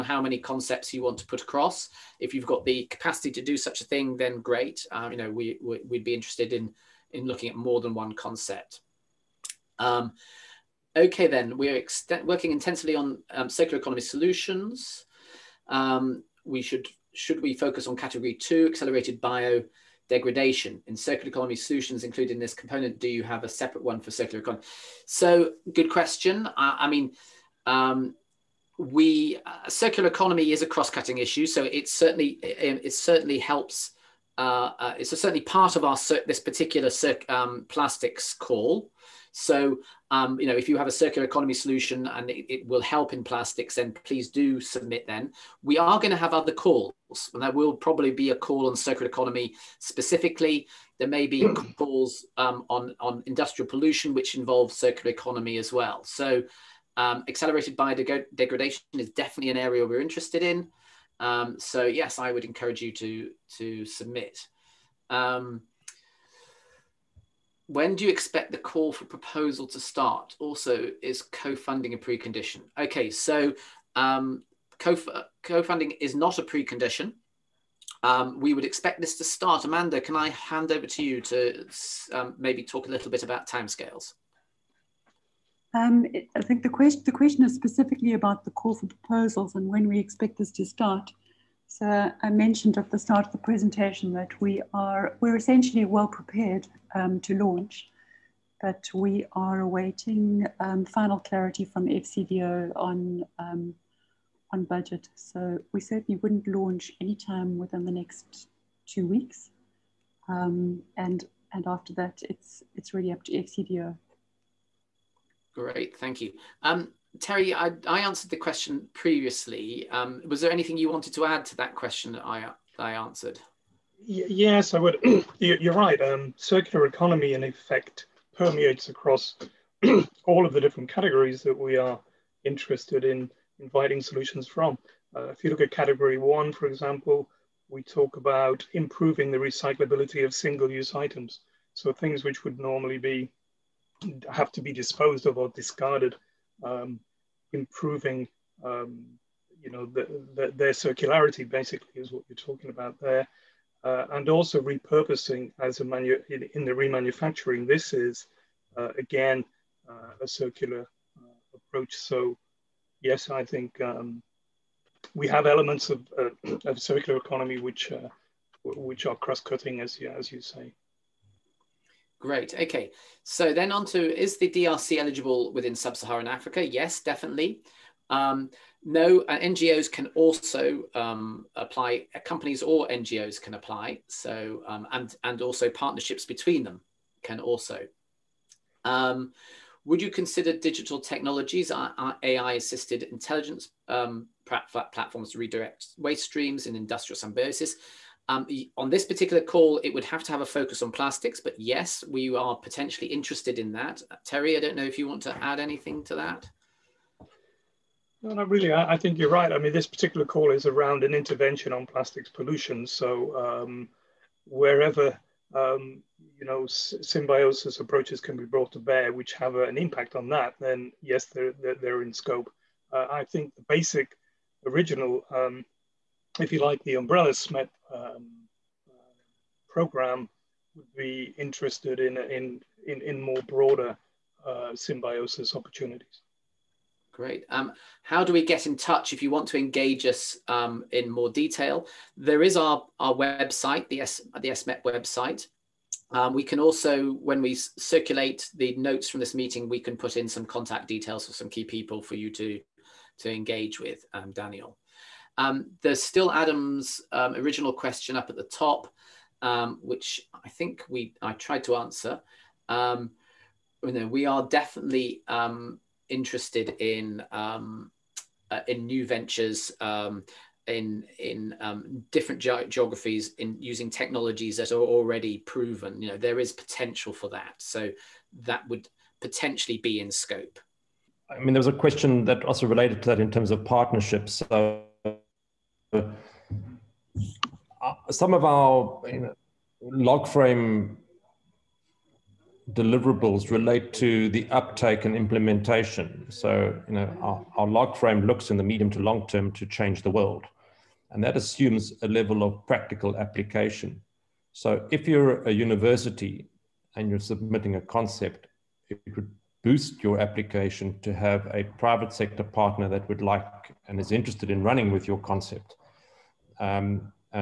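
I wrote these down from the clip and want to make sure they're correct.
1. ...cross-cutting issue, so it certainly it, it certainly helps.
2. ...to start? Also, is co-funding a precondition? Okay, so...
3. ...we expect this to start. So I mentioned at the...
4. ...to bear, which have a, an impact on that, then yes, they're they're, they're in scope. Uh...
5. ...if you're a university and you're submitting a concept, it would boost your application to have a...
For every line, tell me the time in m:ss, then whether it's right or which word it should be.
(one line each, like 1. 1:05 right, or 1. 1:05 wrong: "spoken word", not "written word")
1. 0:30 right
2. 1:09 right
3. 1:29 right
4. 3:38 right
5. 5:04 right.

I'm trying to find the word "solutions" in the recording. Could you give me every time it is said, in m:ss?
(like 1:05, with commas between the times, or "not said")
0:14, 0:21, 0:41, 2:14.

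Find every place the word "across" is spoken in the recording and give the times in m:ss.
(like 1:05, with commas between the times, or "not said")
0:01, 2:08.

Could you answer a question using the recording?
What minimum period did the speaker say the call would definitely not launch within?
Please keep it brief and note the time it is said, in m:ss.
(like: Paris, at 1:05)
Two weeks, at 1:48.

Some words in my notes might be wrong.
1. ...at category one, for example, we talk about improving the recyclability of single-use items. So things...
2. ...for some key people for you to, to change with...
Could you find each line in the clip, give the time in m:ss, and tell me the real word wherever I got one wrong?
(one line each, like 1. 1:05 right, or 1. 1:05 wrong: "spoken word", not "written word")
1. 2:15 right
2. 4:11 wrong: "engage", not "change".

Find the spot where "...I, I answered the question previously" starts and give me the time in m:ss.
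1:57.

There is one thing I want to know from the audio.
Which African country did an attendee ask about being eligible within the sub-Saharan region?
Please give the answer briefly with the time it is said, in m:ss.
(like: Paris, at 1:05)
DRC, at 2:54.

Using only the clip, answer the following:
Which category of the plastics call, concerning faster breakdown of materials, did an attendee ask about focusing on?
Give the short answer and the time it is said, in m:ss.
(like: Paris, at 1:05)
Category two, at 0:17.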